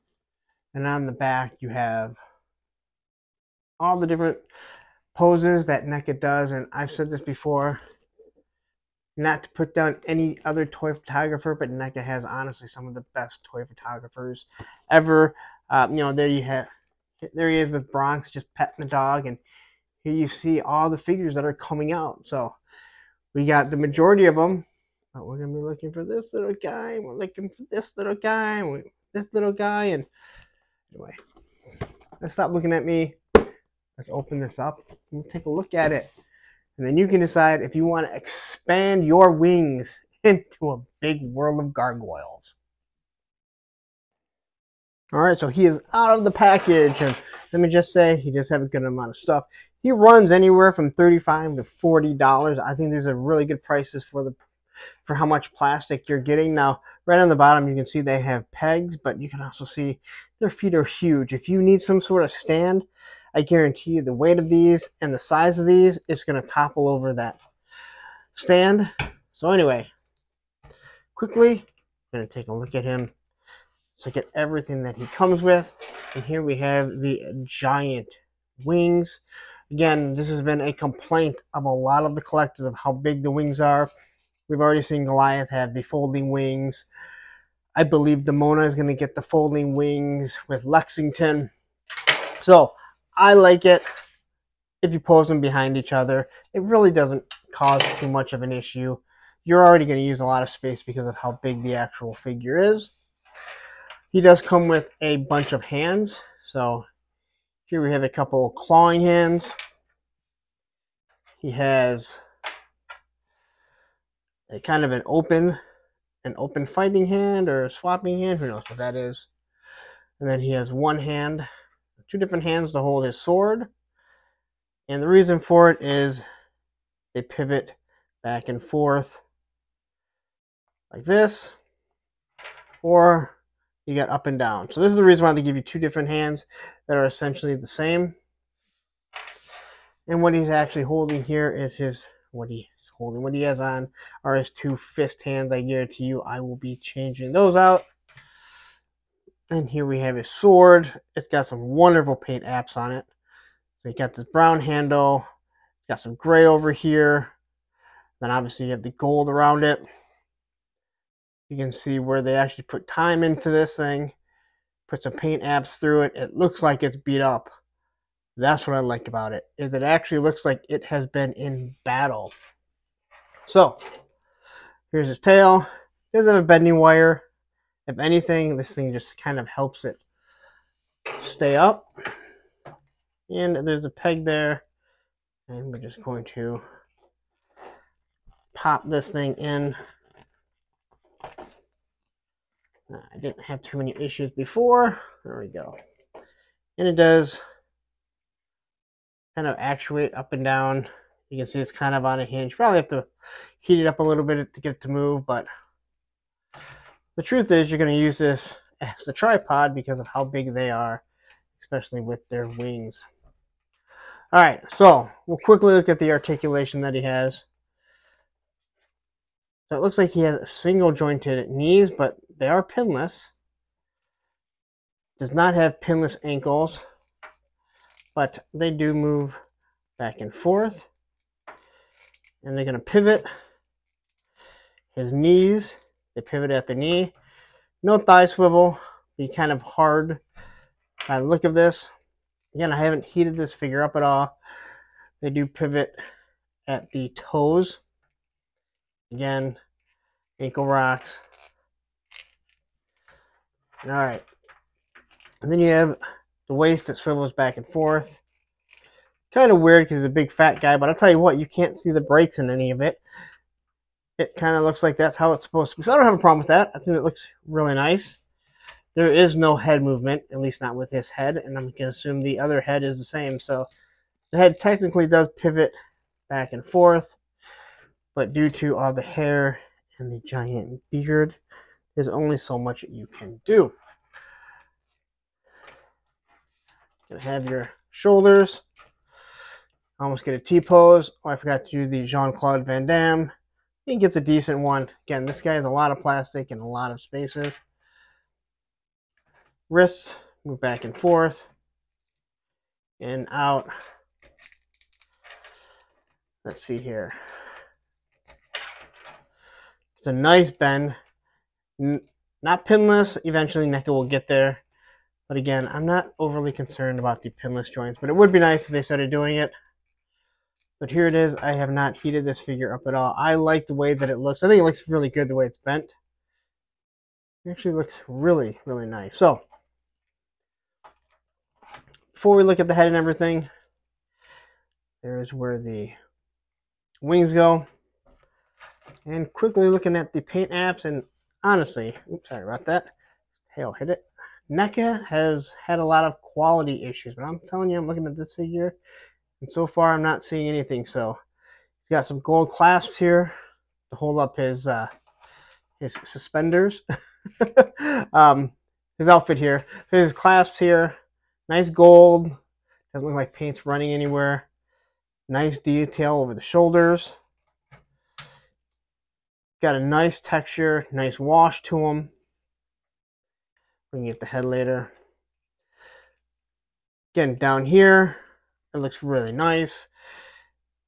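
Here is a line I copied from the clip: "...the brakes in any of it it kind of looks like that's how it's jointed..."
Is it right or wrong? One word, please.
wrong.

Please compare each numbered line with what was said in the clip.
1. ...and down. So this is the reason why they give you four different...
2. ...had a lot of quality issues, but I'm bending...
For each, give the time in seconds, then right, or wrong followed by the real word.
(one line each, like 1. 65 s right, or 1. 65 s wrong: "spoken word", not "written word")
1. 134 s wrong: "two", not "four"
2. 345 s wrong: "telling", not "bending".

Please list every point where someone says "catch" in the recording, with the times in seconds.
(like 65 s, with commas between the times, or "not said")
not said.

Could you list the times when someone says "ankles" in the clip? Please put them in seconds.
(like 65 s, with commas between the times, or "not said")
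226 s, 250 s.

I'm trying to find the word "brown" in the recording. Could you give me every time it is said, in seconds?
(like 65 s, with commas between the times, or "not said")
154 s.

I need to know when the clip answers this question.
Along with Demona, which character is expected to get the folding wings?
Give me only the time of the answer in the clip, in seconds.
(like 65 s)
90 s.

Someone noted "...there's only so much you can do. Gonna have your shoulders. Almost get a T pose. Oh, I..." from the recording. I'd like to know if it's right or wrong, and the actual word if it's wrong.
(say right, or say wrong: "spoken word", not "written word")
right.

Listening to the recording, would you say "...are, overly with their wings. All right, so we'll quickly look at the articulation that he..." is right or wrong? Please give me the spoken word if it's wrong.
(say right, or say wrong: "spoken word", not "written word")
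wrong: "especially", not "overly".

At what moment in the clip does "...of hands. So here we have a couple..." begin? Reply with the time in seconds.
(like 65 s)
105 s.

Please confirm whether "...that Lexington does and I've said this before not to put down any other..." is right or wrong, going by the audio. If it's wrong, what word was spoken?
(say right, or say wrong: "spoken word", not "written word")
wrong: "NECA", not "Lexington".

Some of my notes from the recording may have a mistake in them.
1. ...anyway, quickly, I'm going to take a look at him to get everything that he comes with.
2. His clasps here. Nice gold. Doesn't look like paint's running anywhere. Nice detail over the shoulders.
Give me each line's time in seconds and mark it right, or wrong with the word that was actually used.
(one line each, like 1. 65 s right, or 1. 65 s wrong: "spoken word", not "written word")
1. 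69 s right
2. 359 s right.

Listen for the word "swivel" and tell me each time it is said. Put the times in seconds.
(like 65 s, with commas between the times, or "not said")
238 s, 256 s.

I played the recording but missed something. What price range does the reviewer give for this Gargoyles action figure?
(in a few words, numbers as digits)
$35 to $40.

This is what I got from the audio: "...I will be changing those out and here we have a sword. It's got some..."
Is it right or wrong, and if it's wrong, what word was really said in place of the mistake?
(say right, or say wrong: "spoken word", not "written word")
right.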